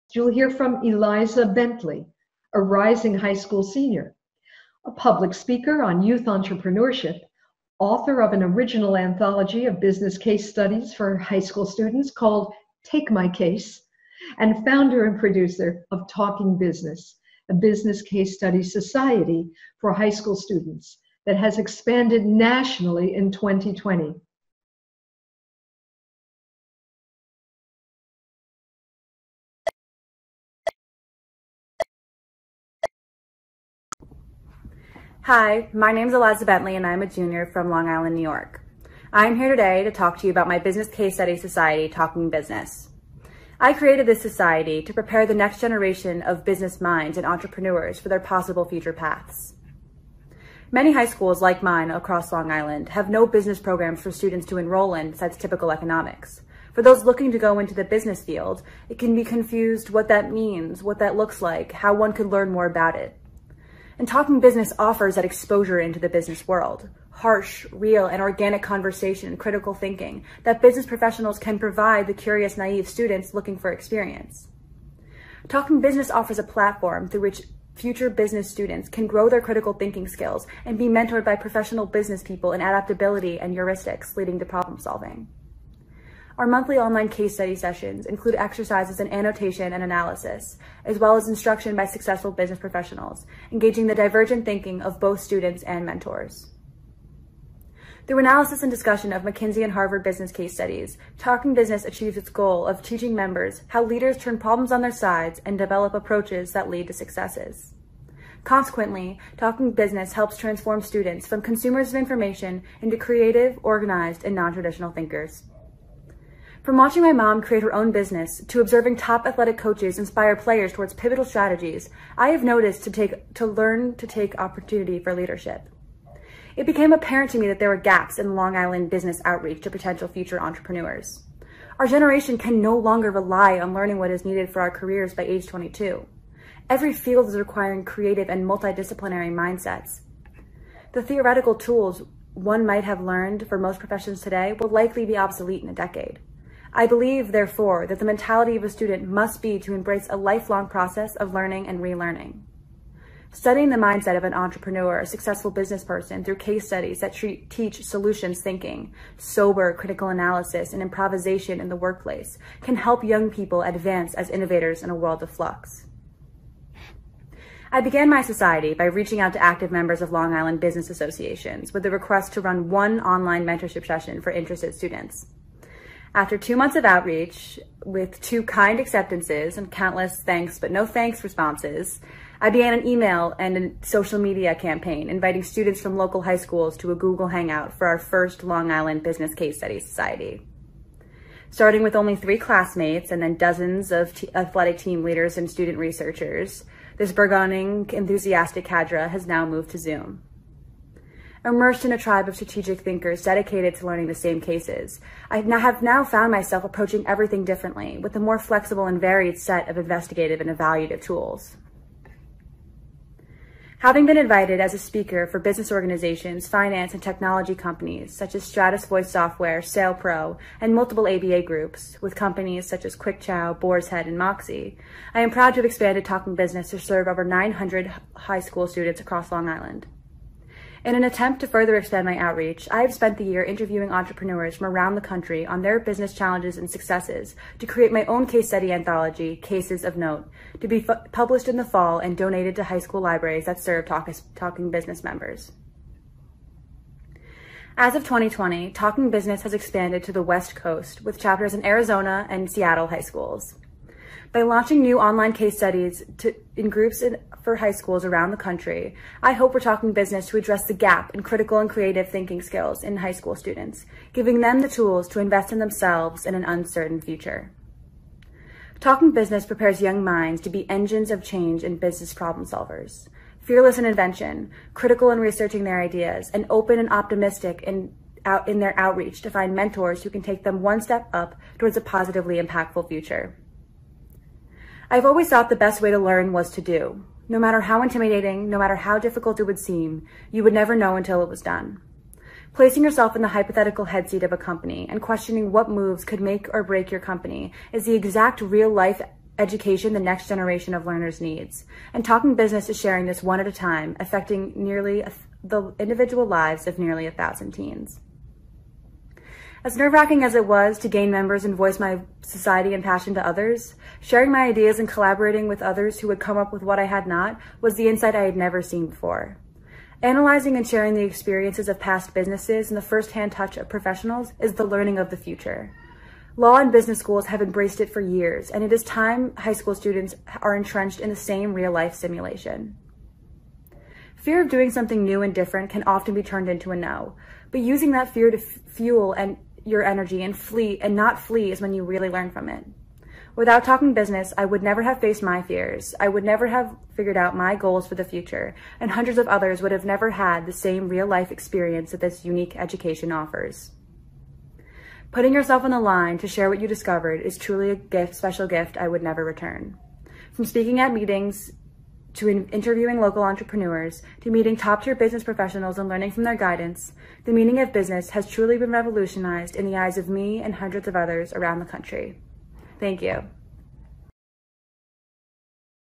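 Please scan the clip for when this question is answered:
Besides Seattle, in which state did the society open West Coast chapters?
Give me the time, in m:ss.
4:11.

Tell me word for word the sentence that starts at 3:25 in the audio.
I have now found myself approaching everything differently with a more flexible and varied set of investigative and evaluative tools.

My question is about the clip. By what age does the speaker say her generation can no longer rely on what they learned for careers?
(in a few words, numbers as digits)
22.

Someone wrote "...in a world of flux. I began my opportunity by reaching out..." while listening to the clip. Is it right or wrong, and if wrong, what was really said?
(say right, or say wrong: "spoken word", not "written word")
wrong: "society", not "opportunity".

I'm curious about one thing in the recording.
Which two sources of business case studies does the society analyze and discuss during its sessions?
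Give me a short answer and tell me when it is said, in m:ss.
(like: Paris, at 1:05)
McKinsey and Harvard, at 1:39.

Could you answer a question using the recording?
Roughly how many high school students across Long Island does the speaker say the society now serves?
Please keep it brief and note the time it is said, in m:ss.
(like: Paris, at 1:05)
over 900, at 3:47.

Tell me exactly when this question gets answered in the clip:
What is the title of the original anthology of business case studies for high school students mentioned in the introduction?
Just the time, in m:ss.
0:12.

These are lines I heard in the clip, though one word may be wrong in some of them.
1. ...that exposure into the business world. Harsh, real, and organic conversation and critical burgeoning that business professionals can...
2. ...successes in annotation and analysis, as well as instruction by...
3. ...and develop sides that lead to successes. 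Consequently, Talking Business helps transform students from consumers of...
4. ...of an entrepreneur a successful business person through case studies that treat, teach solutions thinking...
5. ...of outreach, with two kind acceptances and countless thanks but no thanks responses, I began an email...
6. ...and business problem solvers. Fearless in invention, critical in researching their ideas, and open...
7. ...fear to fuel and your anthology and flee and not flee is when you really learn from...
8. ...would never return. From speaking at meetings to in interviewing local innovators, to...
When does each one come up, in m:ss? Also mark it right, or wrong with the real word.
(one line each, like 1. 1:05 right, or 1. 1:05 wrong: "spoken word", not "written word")
1. 1:05 wrong: "thinking", not "burgeoning"
2. 1:28 wrong: "exercises", not "successes"
3. 1:45 wrong: "approaches", not "sides"
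4. 2:34 right
5. 2:56 right
6. 4:31 right
7. 5:38 wrong: "energy", not "anthology"
8. 5:58 wrong: "entrepreneurs", not "innovators".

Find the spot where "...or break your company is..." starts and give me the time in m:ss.
4:56.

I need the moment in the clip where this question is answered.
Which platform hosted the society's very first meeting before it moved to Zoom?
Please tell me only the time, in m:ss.
3:06.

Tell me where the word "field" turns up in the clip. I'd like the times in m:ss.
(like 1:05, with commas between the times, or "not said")
0:58, 2:16.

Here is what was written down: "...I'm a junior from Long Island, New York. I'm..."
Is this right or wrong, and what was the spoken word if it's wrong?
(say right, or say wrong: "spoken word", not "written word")
right.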